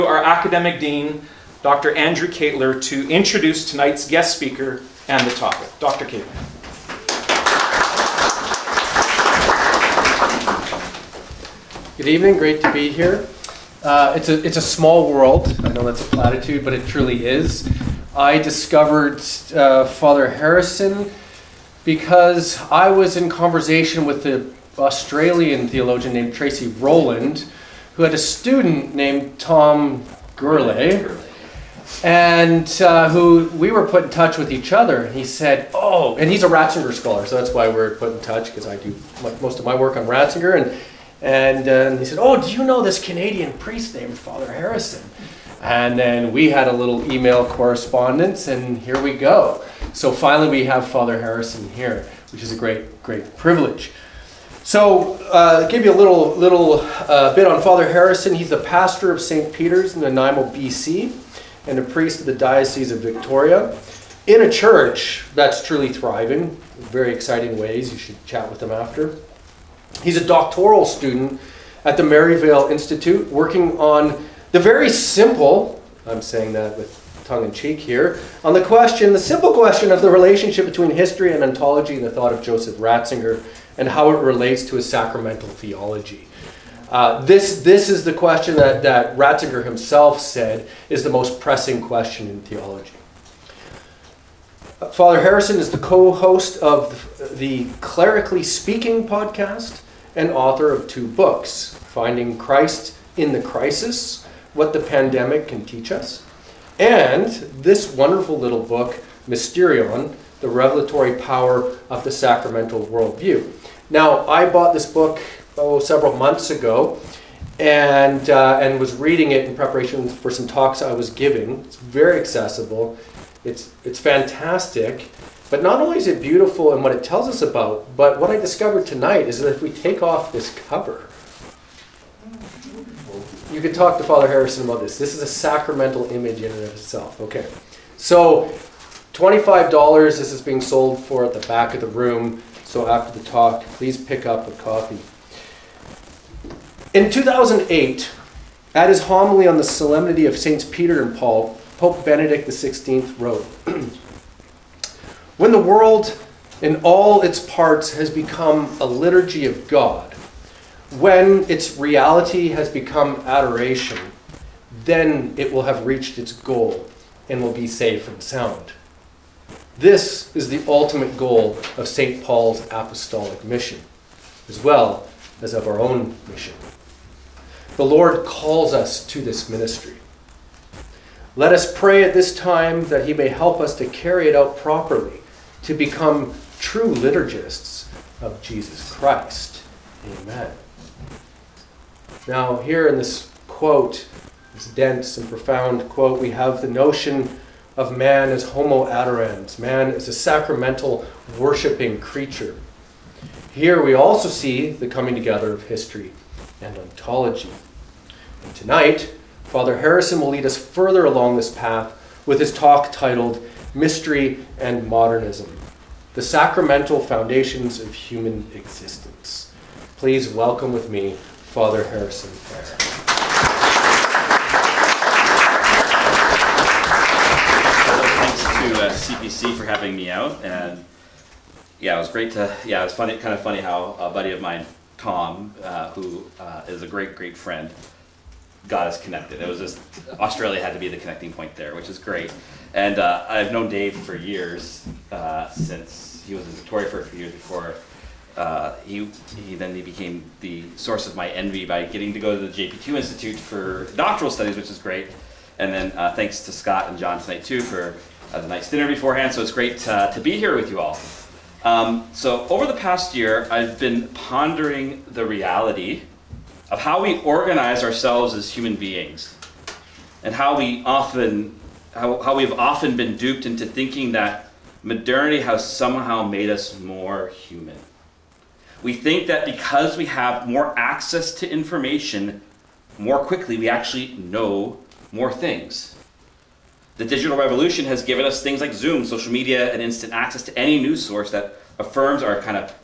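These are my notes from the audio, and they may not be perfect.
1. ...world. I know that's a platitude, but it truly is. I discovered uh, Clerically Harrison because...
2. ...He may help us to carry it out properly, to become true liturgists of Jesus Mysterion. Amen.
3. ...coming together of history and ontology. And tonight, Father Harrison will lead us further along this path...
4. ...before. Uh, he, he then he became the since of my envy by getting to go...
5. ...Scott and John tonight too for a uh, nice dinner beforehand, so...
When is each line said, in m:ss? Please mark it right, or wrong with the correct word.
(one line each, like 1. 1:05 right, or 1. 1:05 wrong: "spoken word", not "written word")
1. 0:15 wrong: "Father", not "Clerically"
2. 3:03 wrong: "Christ", not "Mysterion"
3. 3:24 right
4. 4:07 wrong: "source", not "since"
5. 4:16 right.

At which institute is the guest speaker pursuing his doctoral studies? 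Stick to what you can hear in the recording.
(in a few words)
Maryvale Institute.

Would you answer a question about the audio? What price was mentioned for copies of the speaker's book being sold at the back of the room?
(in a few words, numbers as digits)
$25.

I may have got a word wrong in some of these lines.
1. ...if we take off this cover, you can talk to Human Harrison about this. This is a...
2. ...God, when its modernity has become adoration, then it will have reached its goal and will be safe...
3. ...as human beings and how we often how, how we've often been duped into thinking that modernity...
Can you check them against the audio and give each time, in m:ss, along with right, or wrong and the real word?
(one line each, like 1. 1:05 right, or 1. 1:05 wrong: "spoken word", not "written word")
1. 2:09 wrong: "Father", not "Human"
2. 2:39 wrong: "reality", not "modernity"
3. 4:28 right.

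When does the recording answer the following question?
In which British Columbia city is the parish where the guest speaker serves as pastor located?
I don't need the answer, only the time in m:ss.
1:00.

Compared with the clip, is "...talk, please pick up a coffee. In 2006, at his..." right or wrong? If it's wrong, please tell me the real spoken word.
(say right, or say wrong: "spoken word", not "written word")
wrong: "2008", not "2006".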